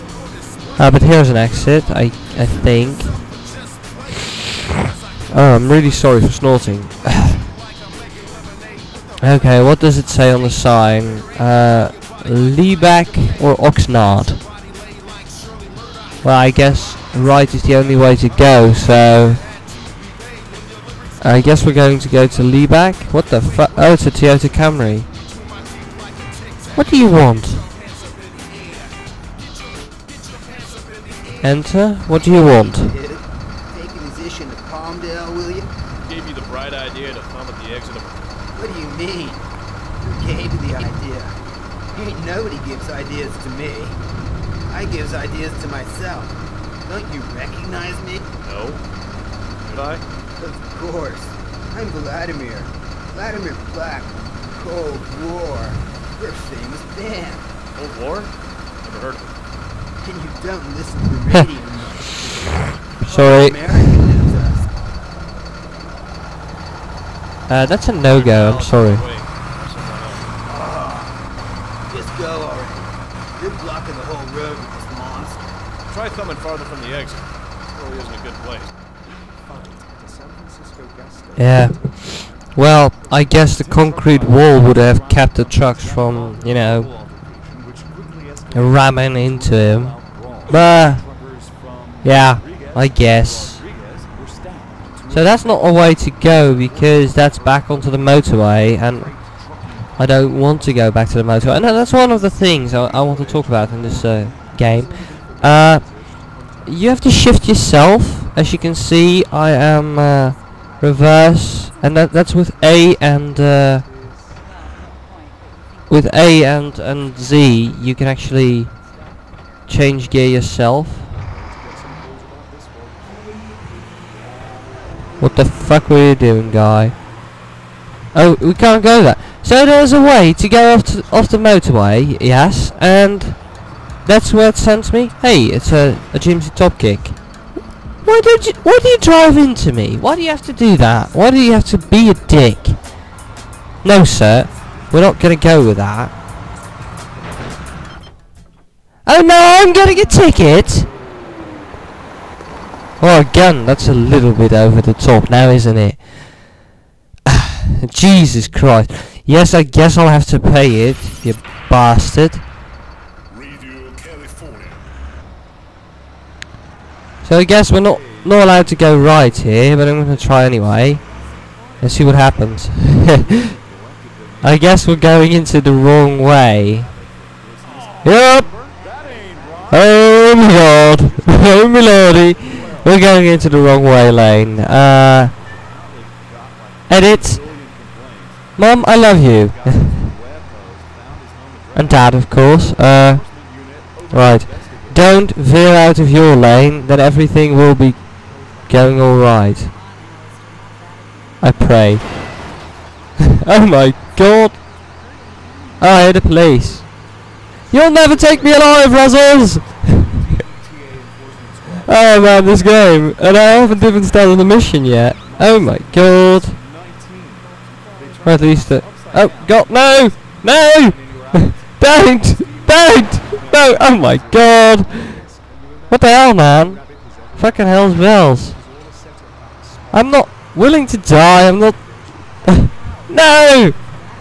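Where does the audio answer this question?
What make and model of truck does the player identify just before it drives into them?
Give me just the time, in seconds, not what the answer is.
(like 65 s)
136 s.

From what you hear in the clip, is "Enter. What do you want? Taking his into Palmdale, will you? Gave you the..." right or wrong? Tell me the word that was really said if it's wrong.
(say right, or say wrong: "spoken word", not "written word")
right.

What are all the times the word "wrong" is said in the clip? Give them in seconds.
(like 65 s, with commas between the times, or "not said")
175 s, 183 s.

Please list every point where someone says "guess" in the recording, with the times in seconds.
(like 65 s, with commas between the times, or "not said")
16 s, 21 s, 83 s, 92 s, 159 s, 167 s, 174 s.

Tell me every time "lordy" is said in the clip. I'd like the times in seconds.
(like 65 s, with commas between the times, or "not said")
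181 s.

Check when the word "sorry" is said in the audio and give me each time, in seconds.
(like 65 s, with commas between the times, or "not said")
5 s, 63 s, 68 s.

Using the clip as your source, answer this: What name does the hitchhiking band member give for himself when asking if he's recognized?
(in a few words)
Vladimir Black.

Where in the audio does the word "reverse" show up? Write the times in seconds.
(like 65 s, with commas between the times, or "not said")
110 s.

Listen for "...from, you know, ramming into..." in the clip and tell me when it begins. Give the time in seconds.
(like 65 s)
85 s.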